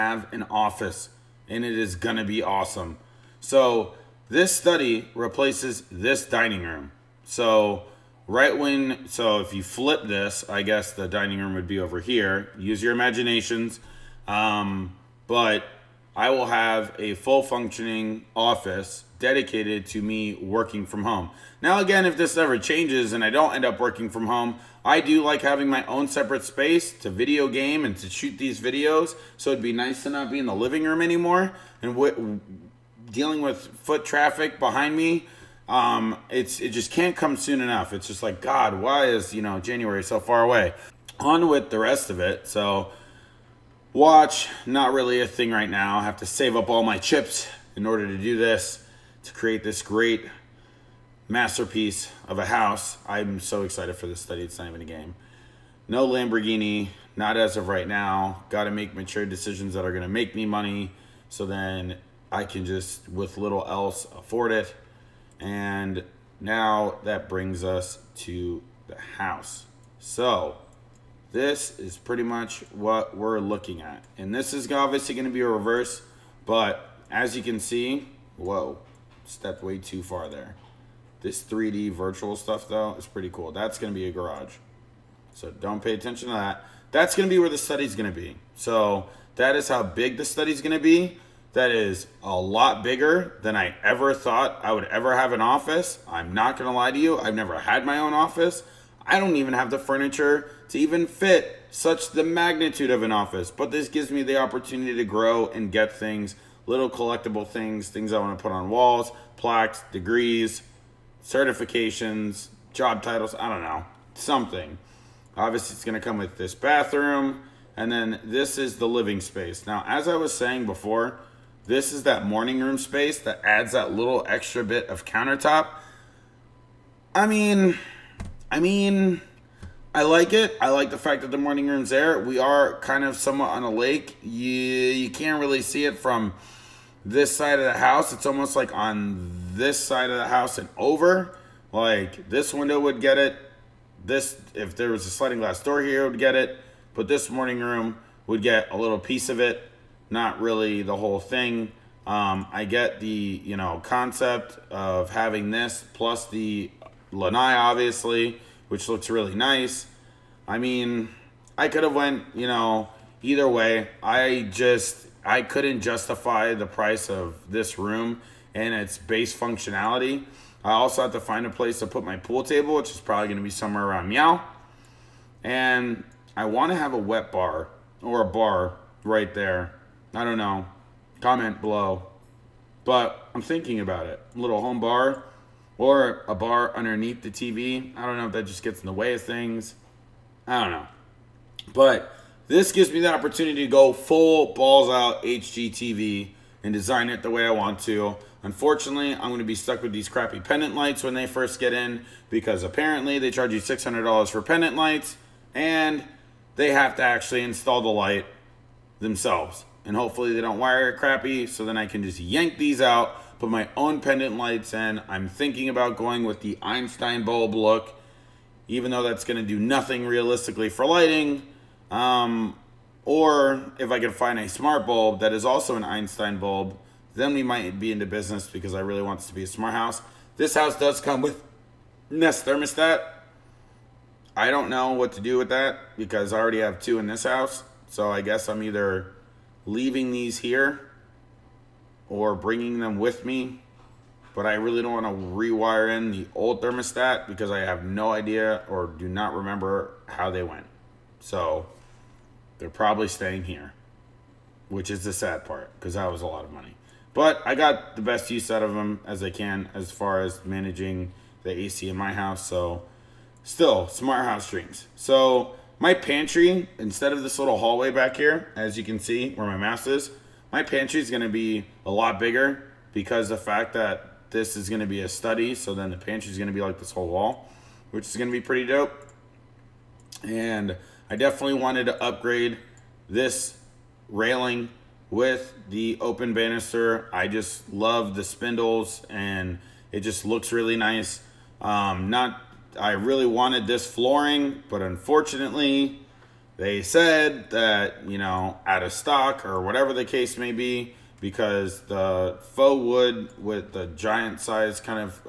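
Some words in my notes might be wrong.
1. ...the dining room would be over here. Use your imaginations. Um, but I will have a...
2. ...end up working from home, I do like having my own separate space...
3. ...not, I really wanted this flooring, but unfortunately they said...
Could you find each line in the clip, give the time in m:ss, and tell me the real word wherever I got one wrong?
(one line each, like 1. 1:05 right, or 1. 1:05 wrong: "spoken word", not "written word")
1. 0:10 right
2. 0:23 right
3. 4:52 right.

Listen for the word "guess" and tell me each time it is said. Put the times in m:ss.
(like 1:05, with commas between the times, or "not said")
0:10, 3:58.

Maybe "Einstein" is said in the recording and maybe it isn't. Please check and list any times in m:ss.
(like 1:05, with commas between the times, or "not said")
3:36, 3:45.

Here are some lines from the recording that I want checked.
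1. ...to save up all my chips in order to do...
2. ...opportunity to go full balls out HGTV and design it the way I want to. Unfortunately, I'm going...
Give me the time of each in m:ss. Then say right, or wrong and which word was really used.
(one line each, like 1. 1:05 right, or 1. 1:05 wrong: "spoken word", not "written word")
1. 0:46 right
2. 3:13 right.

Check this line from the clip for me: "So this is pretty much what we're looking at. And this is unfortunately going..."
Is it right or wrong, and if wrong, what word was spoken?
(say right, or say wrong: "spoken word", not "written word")
wrong: "obviously", not "unfortunately".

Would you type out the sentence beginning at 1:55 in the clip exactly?
Obviously, it's going to come with this bathroom, and then this is the living space.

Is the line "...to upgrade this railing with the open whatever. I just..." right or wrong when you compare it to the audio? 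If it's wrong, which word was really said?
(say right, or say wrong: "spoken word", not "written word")
wrong: "banister", not "whatever".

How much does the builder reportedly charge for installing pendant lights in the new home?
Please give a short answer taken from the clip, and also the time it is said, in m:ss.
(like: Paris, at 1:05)
$600, at 3:23.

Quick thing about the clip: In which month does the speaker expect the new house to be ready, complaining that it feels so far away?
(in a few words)
January.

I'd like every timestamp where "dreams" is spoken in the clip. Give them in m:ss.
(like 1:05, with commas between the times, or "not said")
4:24.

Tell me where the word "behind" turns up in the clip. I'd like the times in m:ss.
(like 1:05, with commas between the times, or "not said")
0:34.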